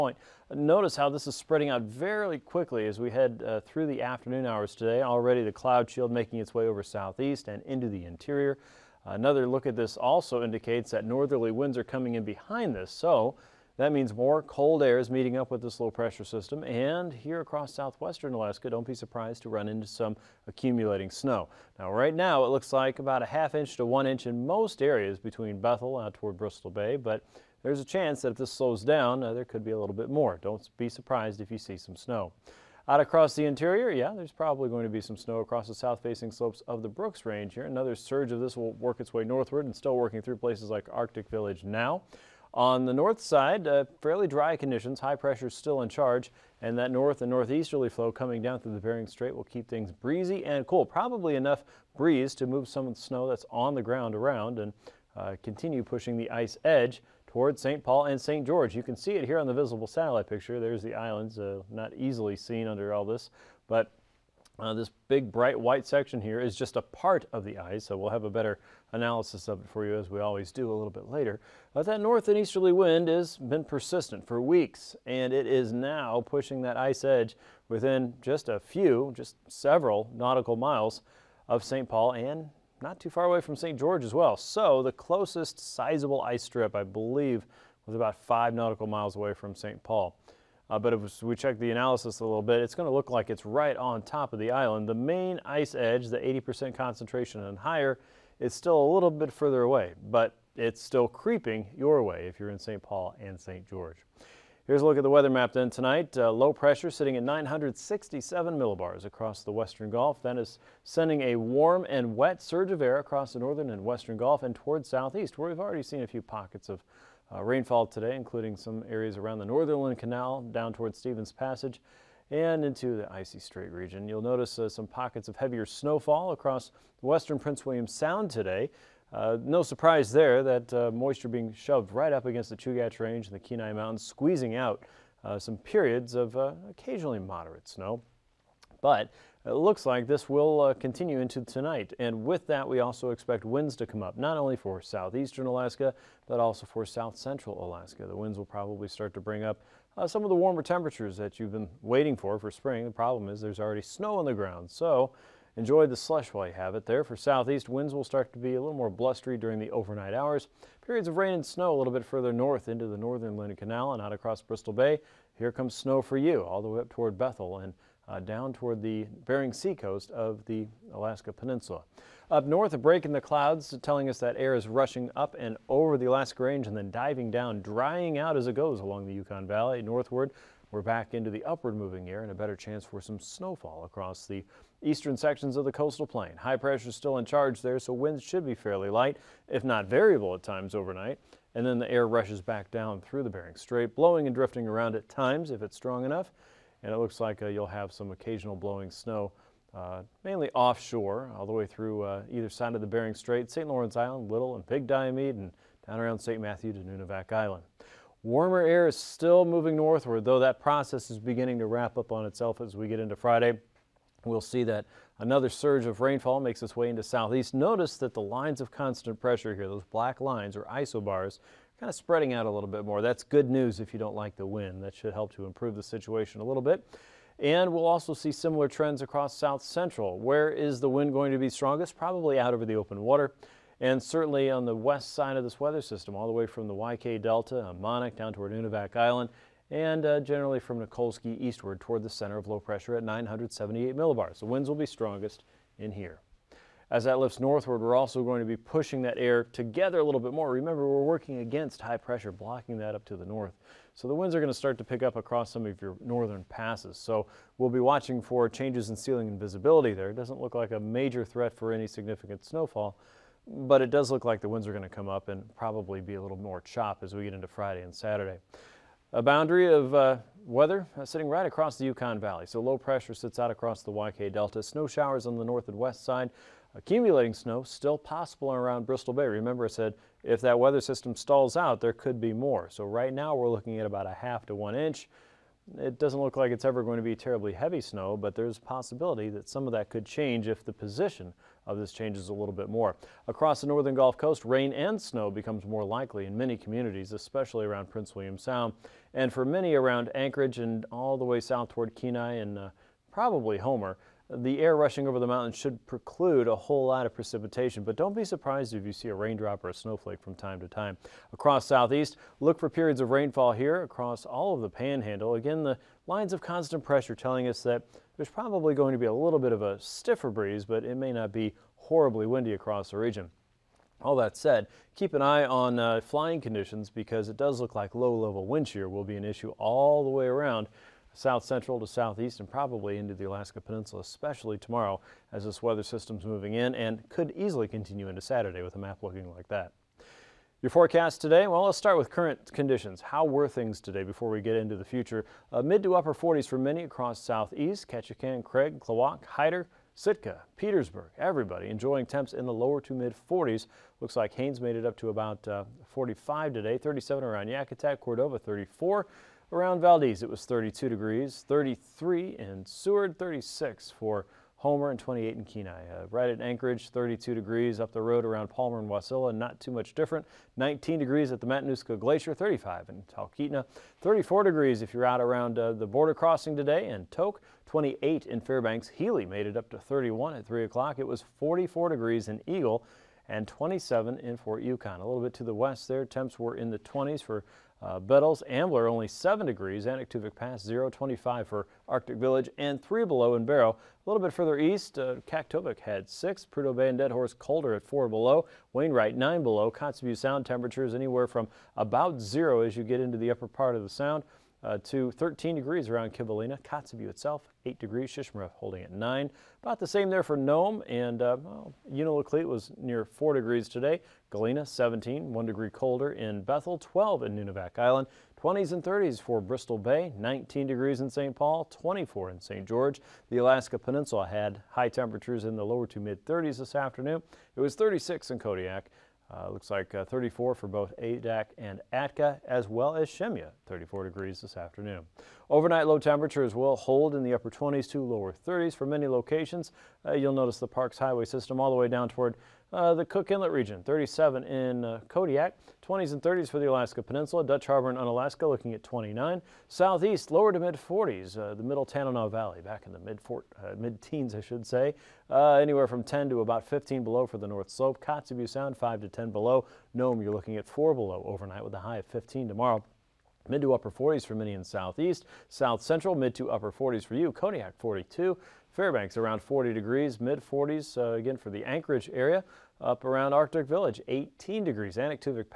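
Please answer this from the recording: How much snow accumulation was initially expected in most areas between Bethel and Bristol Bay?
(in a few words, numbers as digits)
half inch to 1 inch.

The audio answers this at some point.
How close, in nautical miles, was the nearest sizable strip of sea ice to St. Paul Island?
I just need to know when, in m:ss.
1:27.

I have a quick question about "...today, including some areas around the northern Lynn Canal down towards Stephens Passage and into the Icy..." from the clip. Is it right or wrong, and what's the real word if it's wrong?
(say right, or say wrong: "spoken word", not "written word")
right.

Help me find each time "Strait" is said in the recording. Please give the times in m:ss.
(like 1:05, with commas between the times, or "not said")
0:49, 2:03, 3:13, 3:23.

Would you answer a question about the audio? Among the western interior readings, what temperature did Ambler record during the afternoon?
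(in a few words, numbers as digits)
7 degrees.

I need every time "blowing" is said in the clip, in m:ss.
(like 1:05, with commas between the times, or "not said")
3:13, 3:18.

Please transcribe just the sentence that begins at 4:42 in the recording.
So right now we're looking at about a half to one inch.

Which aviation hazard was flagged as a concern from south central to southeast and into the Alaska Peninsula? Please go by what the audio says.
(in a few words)
Low level wind shear.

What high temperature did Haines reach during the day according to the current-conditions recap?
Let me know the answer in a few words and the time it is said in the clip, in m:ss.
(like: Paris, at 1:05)
45, at 5:55.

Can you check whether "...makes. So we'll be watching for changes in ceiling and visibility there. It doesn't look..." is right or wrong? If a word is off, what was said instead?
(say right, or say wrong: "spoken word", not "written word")
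wrong: "passes", not "makes".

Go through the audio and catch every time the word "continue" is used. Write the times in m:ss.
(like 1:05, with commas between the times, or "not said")
0:55, 2:20, 5:37.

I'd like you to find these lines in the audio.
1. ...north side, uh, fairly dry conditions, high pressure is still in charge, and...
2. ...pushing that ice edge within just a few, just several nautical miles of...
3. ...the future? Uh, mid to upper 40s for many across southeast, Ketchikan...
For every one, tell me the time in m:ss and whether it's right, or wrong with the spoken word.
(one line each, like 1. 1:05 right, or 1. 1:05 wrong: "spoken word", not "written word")
1. 0:42 right
2. 1:16 right
3. 5:44 right.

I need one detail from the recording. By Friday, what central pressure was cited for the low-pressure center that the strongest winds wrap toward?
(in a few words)
978 millibars.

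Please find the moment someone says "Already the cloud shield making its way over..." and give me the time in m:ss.
0:05.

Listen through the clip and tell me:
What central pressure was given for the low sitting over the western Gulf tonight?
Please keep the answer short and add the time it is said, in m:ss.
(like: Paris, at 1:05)
967 millibars, at 1:47.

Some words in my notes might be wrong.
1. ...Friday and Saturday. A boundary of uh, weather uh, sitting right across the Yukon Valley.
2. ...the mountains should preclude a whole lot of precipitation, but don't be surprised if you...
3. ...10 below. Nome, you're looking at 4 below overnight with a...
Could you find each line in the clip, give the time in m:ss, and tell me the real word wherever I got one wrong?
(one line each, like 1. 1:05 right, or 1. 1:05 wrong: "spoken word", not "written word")
1. 4:27 right
2. 5:05 right
3. 7:39 right.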